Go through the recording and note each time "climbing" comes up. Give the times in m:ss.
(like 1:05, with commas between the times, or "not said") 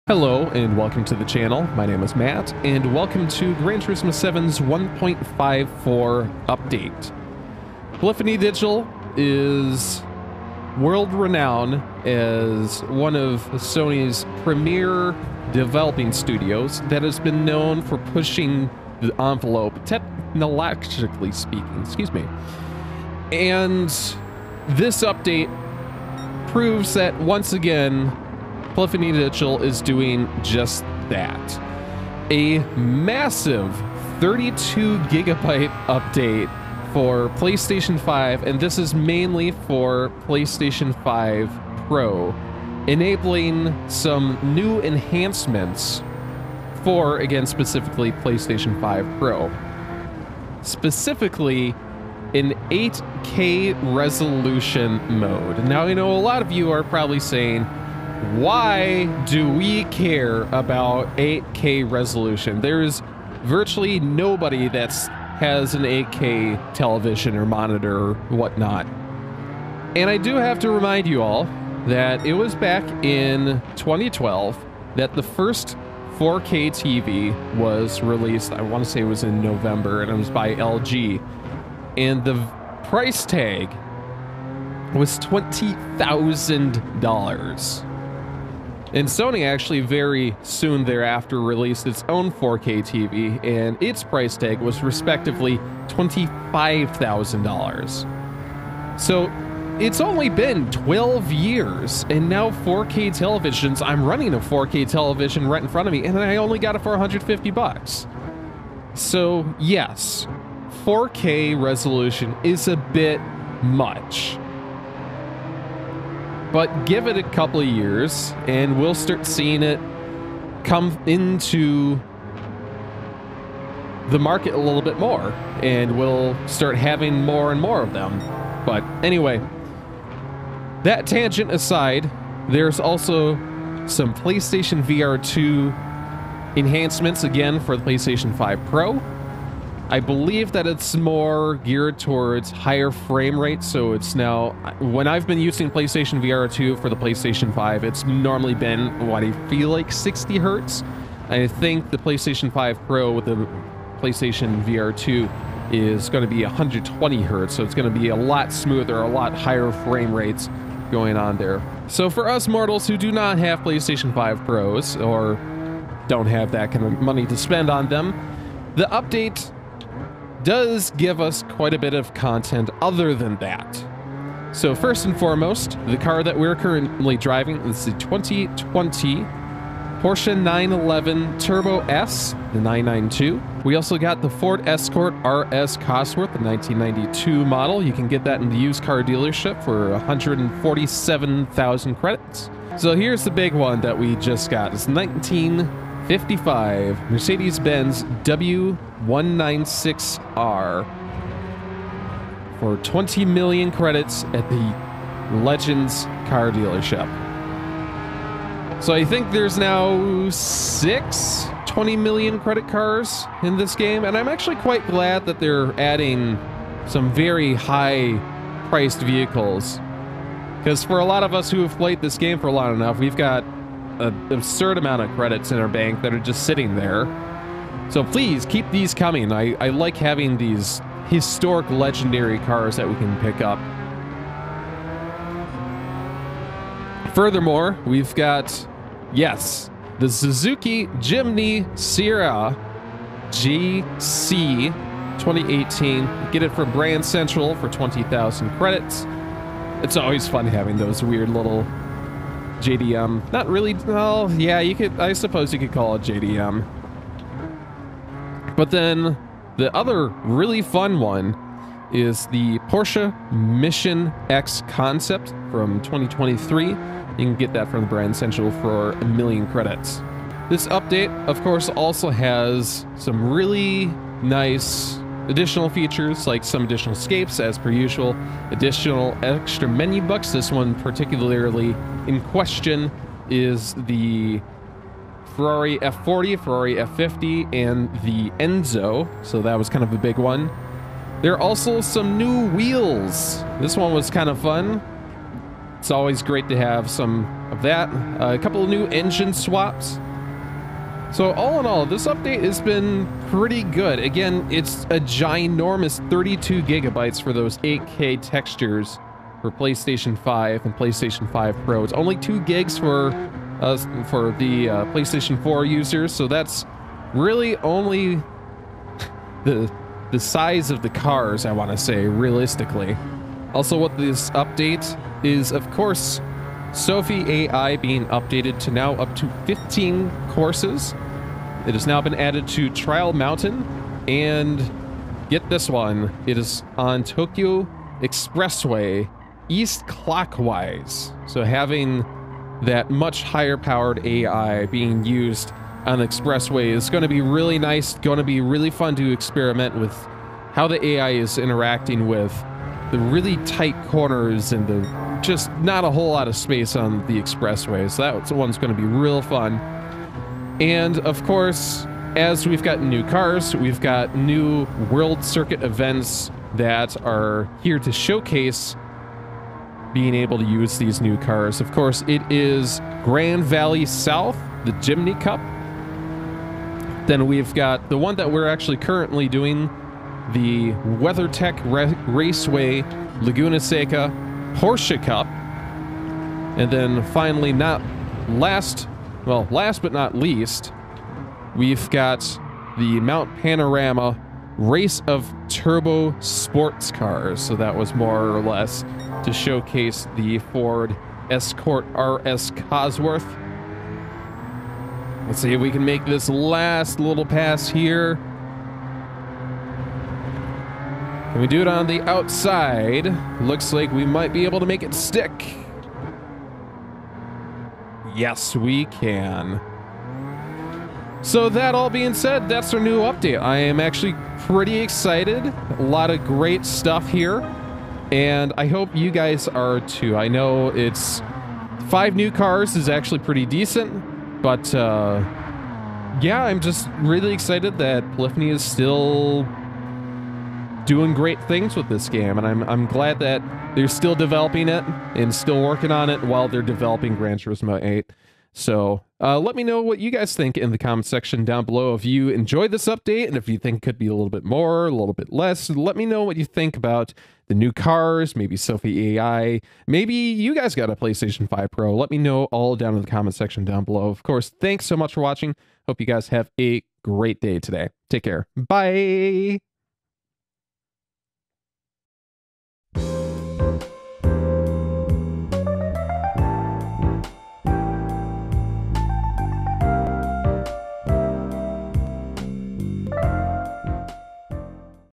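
not said.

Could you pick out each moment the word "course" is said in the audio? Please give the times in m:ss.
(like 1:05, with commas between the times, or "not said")
4:31, 5:25, 5:30, 6:01, 6:11, 7:44.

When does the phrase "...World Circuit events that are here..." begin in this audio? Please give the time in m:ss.
6:04.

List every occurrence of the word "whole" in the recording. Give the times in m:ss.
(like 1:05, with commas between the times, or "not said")
5:55.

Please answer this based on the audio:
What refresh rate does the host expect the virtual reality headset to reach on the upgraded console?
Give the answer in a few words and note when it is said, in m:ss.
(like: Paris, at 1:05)
120 hertz, at 2:36.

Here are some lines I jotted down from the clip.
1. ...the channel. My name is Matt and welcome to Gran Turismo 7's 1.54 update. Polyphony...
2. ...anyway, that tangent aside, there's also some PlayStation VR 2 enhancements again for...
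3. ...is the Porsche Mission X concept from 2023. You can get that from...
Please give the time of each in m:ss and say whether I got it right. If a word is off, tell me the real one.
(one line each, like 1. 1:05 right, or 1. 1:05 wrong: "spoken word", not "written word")
1. 0:01 right
2. 2:09 right
3. 4:21 right.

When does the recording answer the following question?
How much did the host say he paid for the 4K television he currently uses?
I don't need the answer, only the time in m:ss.
1:46.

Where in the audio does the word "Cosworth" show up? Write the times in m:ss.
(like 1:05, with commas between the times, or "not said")
3:05, 6:42.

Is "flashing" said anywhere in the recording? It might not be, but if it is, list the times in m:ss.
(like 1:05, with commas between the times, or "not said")
not said.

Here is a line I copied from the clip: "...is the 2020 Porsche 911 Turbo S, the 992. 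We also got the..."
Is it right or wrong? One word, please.
right.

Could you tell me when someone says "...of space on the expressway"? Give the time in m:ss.
5:56.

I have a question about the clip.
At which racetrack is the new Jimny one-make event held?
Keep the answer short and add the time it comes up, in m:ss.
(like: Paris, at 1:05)
Grand Valley South, at 6:13.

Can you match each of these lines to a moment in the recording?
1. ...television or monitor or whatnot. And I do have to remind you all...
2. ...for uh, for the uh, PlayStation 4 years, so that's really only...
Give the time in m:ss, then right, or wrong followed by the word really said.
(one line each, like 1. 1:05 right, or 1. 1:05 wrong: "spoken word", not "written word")
1. 1:06 right
2. 5:12 wrong: "users", not "years".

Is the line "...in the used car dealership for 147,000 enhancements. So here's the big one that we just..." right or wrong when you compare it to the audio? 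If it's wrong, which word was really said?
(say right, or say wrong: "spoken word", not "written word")
wrong: "credits", not "enhancements".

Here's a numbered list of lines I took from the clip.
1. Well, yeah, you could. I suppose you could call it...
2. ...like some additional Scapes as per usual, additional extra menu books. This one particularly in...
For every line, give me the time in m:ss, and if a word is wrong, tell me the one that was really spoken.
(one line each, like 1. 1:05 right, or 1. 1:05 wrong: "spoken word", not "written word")
1. 4:13 right
2. 4:36 right.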